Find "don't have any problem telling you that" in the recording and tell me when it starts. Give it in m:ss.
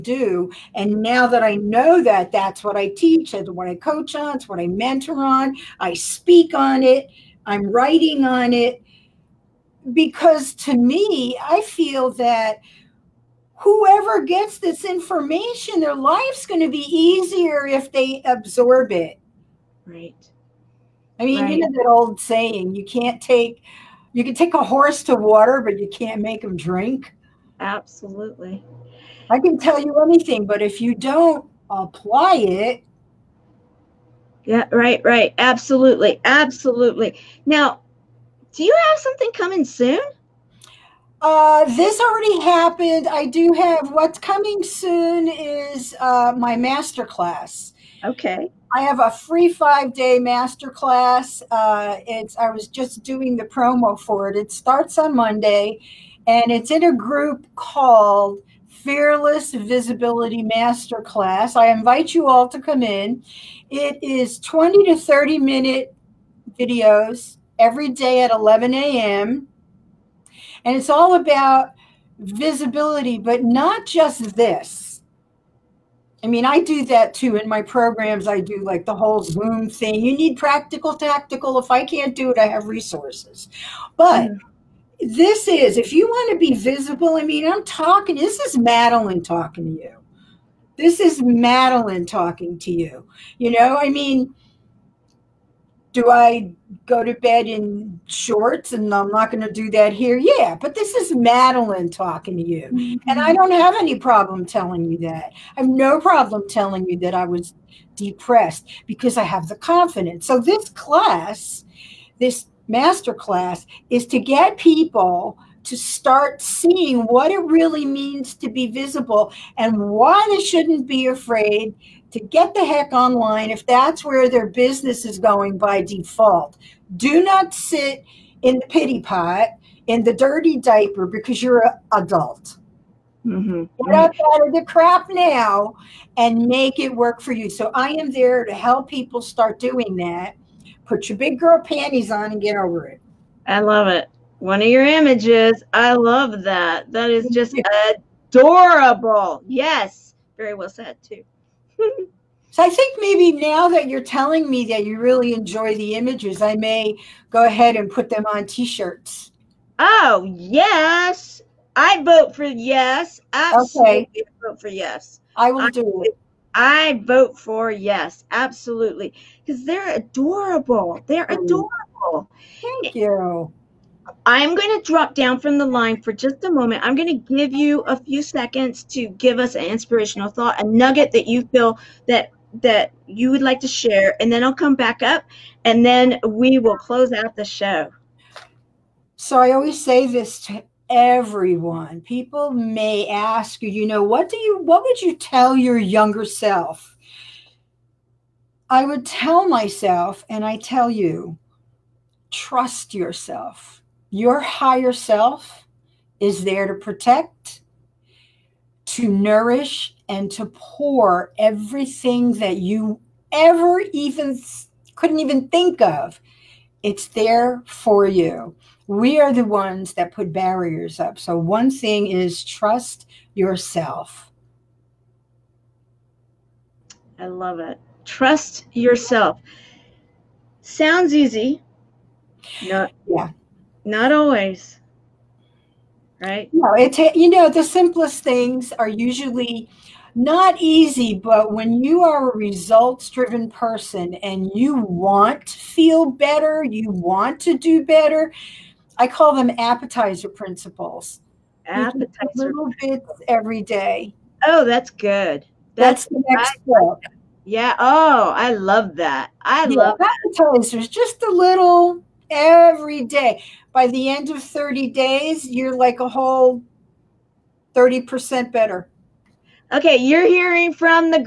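1:43.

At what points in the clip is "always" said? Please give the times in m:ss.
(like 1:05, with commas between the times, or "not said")
3:09, 3:54.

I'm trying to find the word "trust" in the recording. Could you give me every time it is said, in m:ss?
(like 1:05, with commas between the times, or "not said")
3:22, 3:42, 3:48.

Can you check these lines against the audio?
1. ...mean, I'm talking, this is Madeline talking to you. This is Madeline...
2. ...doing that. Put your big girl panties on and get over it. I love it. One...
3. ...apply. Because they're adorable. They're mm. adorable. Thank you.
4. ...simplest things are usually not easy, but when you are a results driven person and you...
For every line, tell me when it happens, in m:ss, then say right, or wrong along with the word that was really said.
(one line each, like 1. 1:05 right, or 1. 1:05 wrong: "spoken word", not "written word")
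1. 1:27 right
2. 2:19 right
3. 2:48 wrong: "absolutely", not "apply"
4. 3:57 right.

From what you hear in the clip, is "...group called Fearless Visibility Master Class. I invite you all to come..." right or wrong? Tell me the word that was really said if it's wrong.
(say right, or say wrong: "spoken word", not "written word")
right.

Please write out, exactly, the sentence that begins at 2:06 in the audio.
Do not sit in the pity pot, in the dirty diaper, because you're an adult.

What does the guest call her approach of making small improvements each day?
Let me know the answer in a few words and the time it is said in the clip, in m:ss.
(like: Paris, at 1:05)
Appetizer principles, at 4:09.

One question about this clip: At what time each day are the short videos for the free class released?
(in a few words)
11 a.m.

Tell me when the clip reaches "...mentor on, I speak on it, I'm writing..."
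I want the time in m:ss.
0:04.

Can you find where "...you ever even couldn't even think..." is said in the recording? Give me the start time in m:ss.
3:32.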